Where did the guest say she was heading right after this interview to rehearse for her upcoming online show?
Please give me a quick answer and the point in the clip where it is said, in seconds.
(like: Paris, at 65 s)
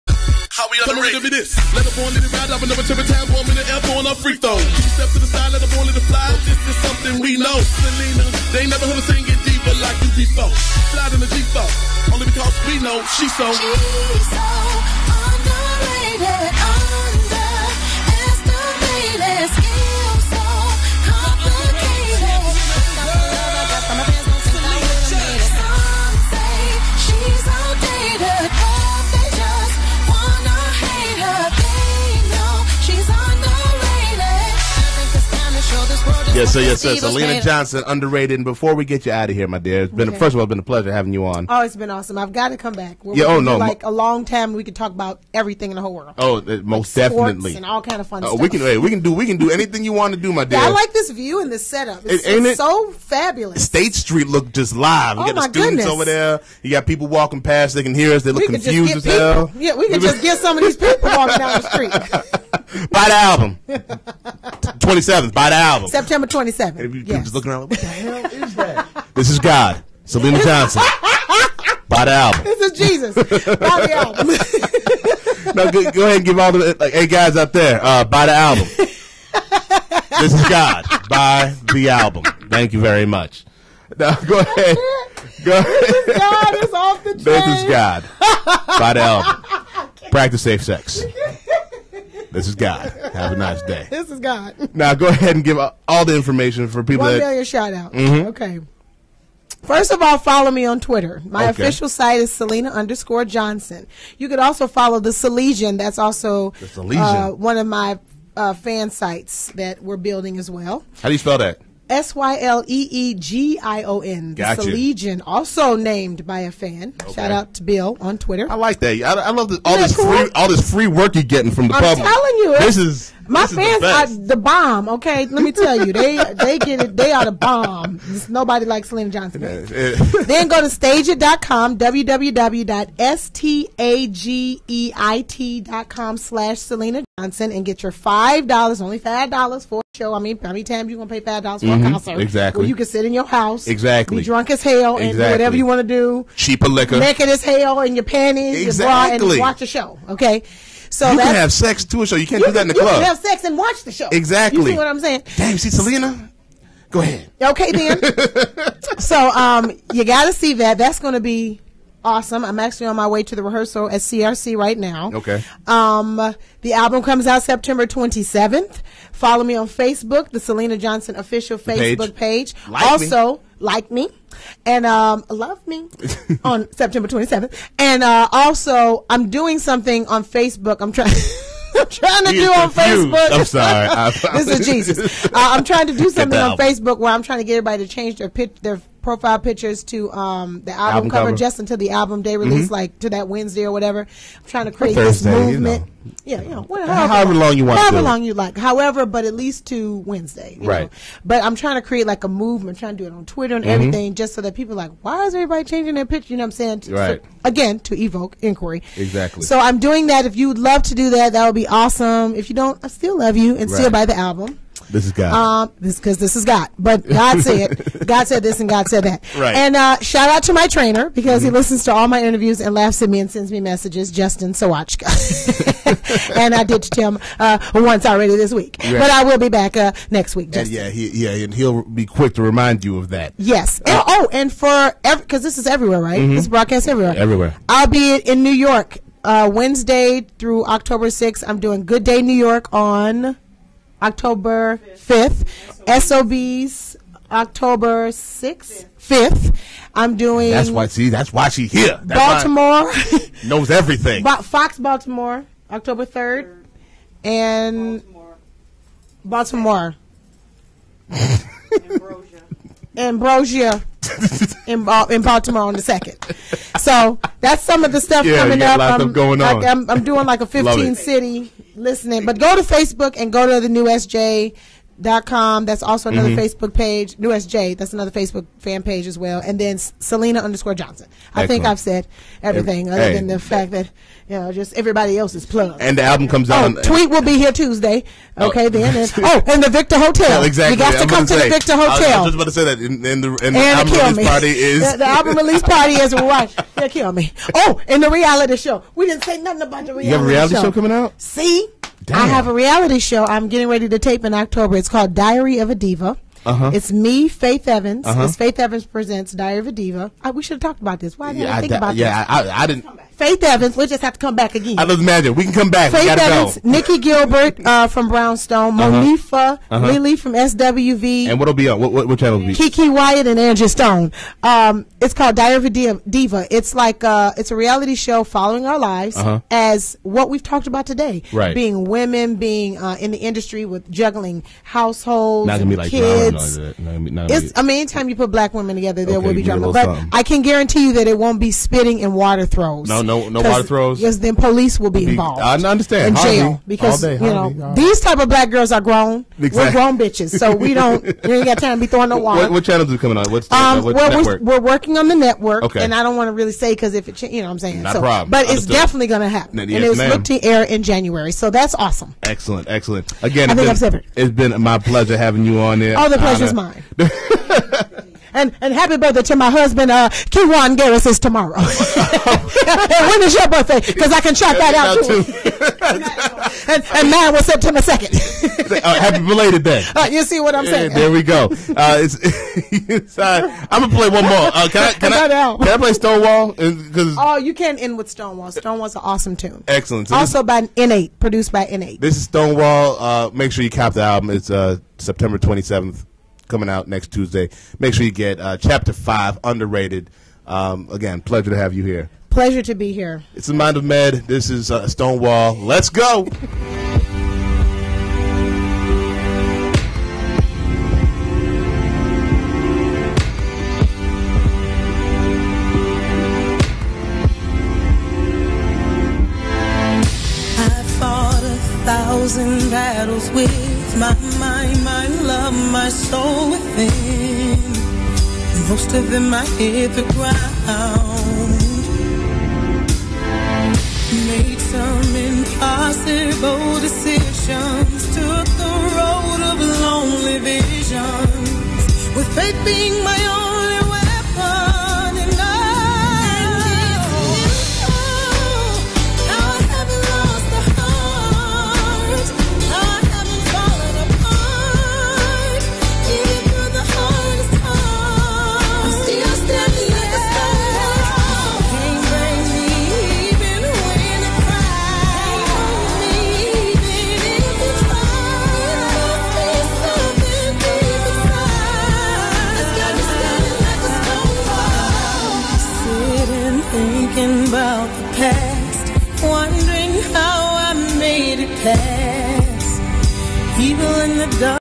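CRC, at 164 s.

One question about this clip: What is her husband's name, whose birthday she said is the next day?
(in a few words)
Kiwane Garris.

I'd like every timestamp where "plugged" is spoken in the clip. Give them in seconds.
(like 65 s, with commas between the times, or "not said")
285 s.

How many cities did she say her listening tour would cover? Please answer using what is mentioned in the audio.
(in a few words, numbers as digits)
15.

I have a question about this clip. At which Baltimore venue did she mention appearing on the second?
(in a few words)
Ambrosia.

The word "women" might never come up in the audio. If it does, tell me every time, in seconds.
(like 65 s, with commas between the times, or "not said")
331 s, 338 s.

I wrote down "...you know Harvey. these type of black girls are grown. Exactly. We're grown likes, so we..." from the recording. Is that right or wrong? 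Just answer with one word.
wrong.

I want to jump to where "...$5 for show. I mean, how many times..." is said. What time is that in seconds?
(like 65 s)
138 s.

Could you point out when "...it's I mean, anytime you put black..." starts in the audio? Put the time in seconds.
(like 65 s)
337 s.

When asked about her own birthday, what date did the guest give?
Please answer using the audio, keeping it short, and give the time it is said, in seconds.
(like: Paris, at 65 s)
September 2, at 377 s.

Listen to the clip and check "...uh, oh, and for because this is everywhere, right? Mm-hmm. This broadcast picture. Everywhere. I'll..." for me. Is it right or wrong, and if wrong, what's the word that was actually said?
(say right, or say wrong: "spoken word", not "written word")
wrong: "everywhere", not "picture".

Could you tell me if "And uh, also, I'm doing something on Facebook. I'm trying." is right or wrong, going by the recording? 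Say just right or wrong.
right.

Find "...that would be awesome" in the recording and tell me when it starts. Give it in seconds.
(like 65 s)
211 s.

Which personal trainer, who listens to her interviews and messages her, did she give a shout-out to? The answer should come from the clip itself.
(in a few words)
Justin Sawatchka.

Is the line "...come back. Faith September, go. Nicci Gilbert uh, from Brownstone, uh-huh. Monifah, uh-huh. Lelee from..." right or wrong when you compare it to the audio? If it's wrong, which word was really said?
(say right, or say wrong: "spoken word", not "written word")
wrong: "Evans", not "September".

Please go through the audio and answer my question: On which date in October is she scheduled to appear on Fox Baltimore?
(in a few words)
October 3.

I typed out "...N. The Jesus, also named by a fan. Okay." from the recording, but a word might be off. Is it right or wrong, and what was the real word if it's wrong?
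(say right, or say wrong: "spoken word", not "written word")
wrong: "Legion", not "Jesus".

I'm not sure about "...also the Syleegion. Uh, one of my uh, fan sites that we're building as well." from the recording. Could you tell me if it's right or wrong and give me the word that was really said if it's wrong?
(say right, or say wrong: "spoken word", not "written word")
right.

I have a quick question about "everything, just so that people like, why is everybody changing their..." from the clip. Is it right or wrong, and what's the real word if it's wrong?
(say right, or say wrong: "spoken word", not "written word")
right.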